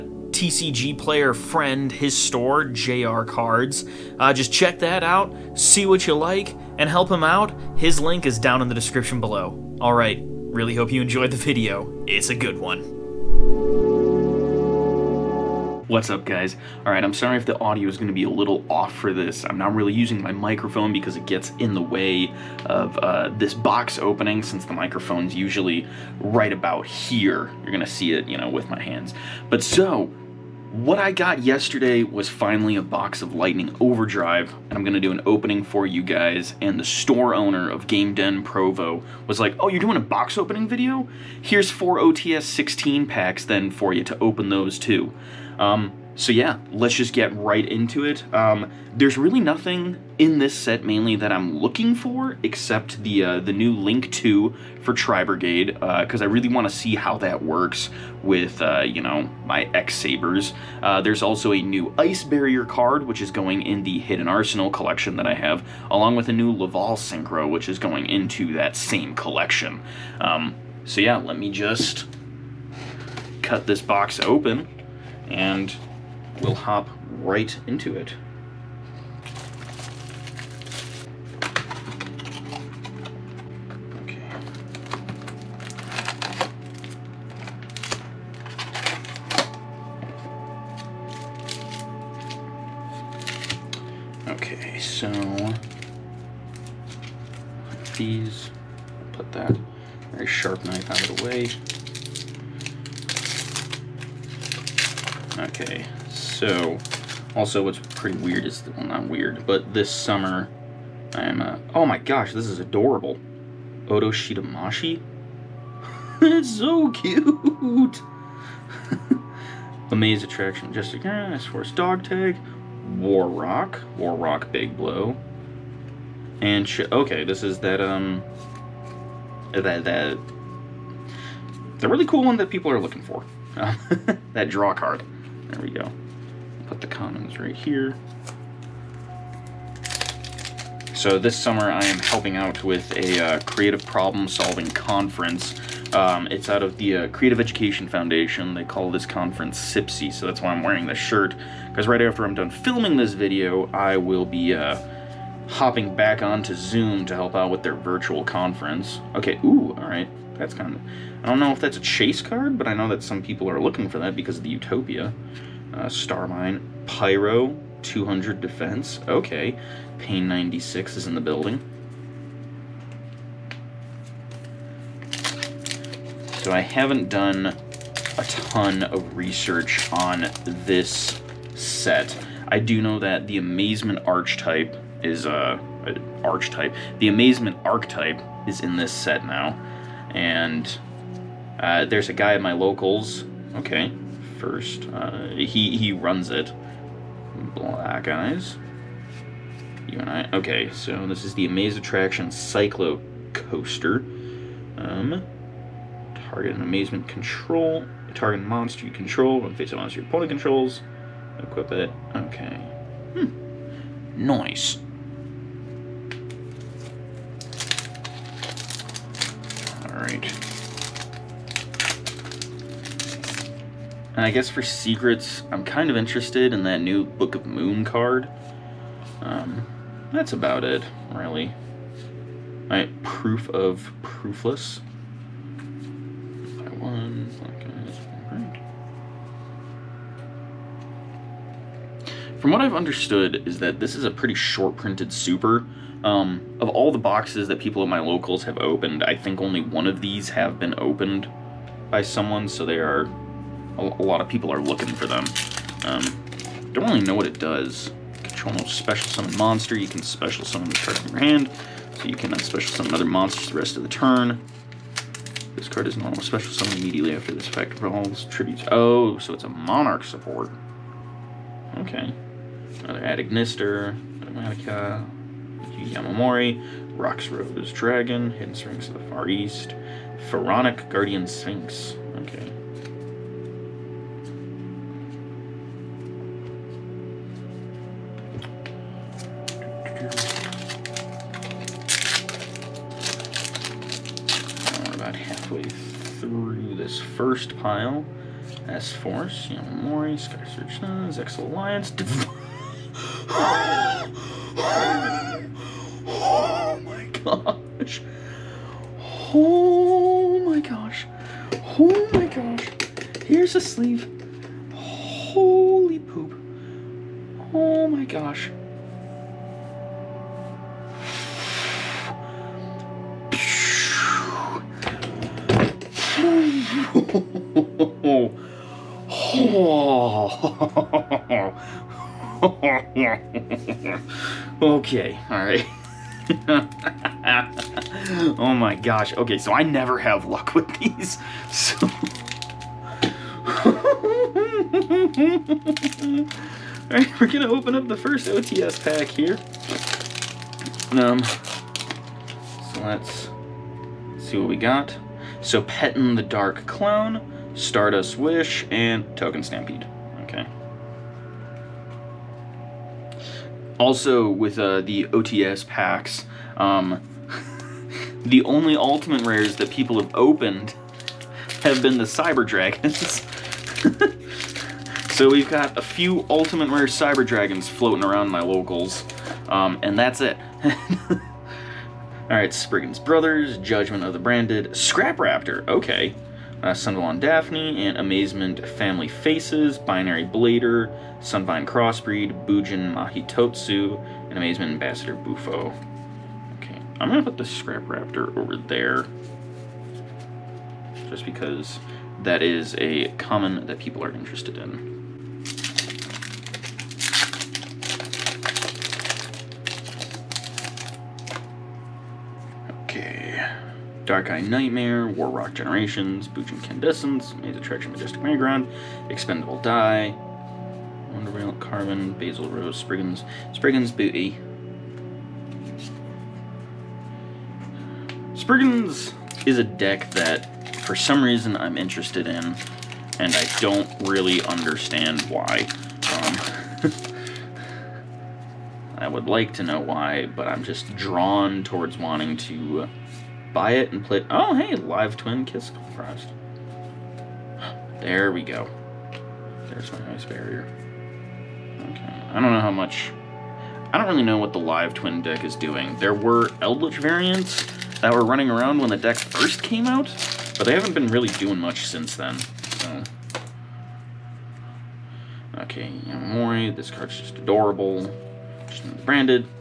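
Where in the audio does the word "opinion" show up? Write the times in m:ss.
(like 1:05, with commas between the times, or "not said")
not said.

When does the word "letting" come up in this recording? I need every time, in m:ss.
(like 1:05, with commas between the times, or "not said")
not said.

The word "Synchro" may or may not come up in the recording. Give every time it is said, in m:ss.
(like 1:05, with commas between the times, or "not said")
1:06.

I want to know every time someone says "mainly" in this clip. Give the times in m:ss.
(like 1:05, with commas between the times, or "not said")
0:50.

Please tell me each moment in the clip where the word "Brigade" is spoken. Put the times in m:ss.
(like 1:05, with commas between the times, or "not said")
0:55.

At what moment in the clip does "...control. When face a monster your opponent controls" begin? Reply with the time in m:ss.
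3:28.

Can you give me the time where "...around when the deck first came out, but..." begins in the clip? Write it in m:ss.
7:38.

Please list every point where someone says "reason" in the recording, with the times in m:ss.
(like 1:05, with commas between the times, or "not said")
7:11.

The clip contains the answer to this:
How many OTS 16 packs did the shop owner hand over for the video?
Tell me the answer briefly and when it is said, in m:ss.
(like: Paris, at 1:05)
4, at 0:41.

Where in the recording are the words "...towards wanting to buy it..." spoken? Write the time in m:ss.
7:21.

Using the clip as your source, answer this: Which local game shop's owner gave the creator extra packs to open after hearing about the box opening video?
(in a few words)
Game Den Provo.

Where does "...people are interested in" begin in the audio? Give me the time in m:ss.
6:43.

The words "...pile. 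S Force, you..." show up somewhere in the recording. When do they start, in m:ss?
4:57.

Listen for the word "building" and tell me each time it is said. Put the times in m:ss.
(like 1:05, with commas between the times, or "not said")
2:51.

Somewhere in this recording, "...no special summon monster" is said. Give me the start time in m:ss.
4:18.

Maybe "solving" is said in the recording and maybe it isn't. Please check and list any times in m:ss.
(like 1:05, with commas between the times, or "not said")
2:24.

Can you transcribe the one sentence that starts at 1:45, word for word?
Okay, so, also what's pretty weird is, well not weird, but this summer I am, uh, oh my gosh, this is adorable.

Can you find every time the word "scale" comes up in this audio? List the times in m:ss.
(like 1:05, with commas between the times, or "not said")
not said.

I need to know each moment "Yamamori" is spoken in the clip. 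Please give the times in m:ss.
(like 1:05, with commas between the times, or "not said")
4:35, 7:46.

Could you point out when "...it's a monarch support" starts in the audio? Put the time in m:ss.
4:29.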